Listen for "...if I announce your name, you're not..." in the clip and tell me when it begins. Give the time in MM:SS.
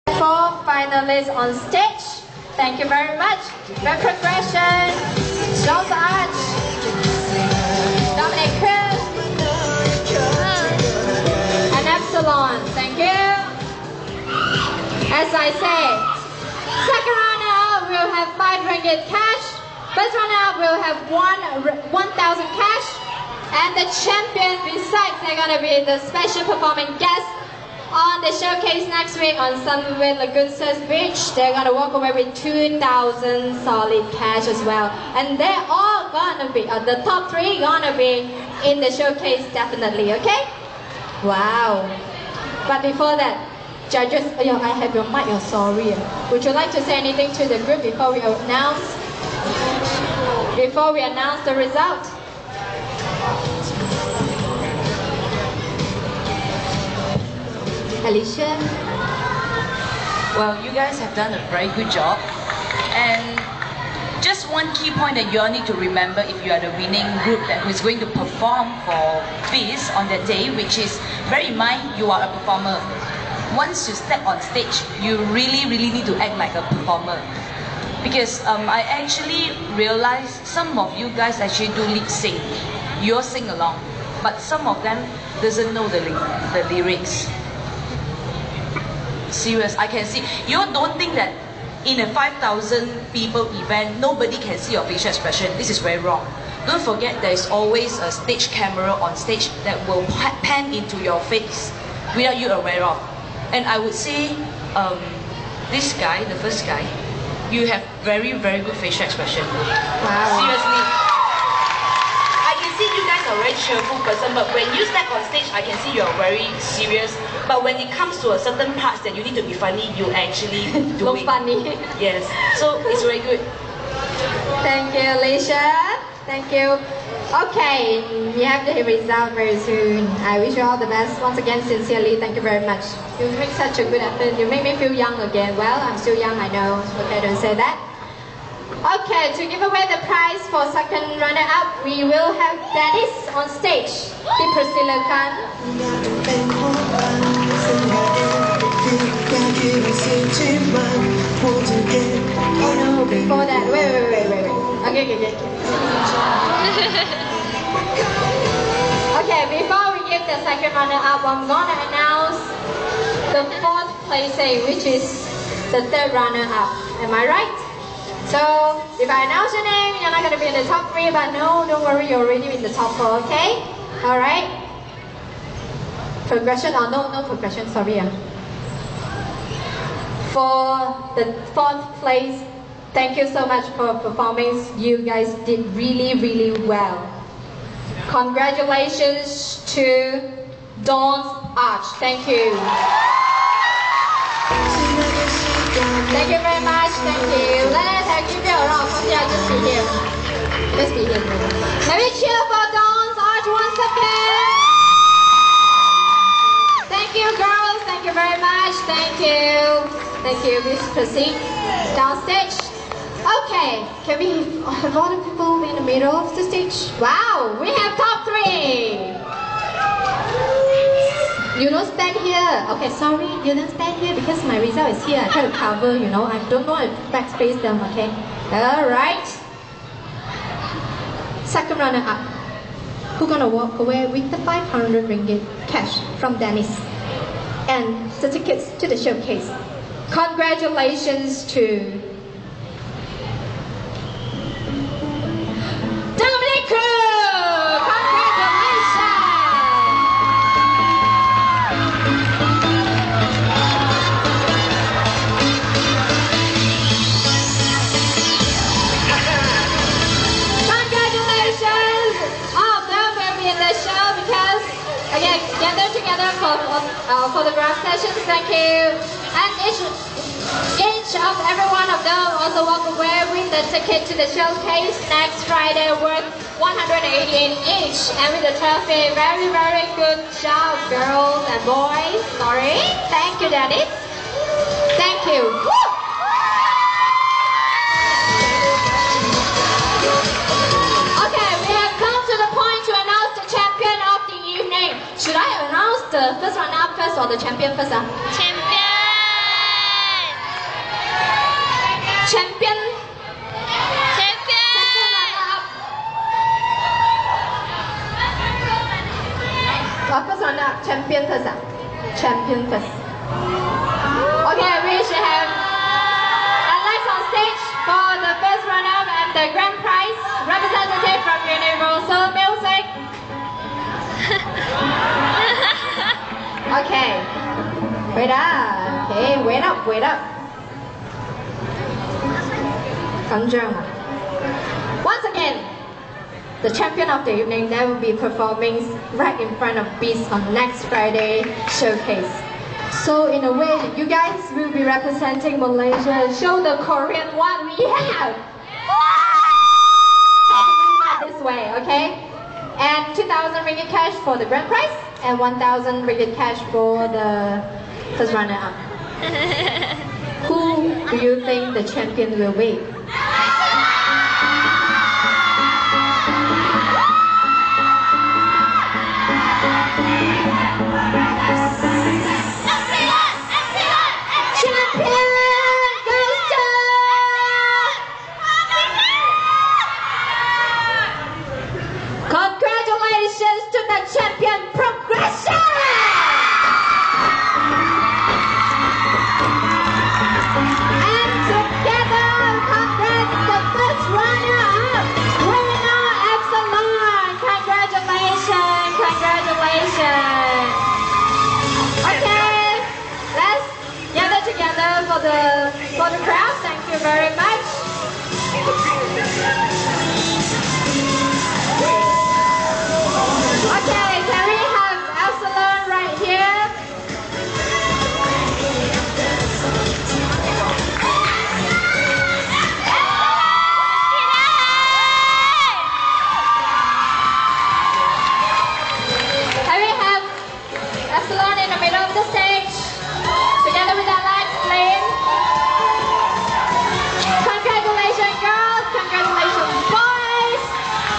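02:48.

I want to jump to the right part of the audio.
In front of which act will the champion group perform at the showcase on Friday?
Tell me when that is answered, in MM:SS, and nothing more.
05:40.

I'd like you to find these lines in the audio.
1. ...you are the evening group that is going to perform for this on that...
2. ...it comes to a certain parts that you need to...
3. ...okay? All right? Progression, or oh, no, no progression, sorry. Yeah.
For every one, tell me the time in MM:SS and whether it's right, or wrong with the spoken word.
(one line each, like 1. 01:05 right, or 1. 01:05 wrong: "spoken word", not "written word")
1. 01:06 wrong: "winning", not "evening"
2. 01:57 right
3. 02:53 right.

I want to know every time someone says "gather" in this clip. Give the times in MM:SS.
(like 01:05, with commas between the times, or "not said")
04:25.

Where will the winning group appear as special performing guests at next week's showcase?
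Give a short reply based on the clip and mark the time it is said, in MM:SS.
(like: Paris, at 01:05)
Sunway Lagoon Surf Beach, at 00:29.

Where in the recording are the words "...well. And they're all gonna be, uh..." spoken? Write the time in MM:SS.
00:34.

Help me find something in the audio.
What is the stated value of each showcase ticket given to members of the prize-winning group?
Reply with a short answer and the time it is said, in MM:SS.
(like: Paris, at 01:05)
118, at 04:36.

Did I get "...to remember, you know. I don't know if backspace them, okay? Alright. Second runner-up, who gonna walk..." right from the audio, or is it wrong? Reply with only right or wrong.
wrong.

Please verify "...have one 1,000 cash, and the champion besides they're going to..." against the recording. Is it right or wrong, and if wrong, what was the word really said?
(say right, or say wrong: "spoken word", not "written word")
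right.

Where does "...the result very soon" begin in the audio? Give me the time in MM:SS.
02:08.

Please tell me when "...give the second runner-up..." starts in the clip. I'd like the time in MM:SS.
02:40.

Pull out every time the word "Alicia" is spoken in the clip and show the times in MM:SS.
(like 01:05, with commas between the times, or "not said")
00:58, 02:05.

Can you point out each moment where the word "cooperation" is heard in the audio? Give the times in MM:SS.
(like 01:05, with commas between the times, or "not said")
not said.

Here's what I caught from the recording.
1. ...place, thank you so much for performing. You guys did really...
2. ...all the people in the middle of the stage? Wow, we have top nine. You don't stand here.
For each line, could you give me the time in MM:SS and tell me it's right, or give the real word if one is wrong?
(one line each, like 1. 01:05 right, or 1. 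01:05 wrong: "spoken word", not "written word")
1. 03:01 right
2. 03:34 wrong: "three", not "nine".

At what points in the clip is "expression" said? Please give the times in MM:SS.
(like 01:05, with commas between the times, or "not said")
01:35, 01:49.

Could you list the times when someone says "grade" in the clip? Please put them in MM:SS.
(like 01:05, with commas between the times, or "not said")
not said.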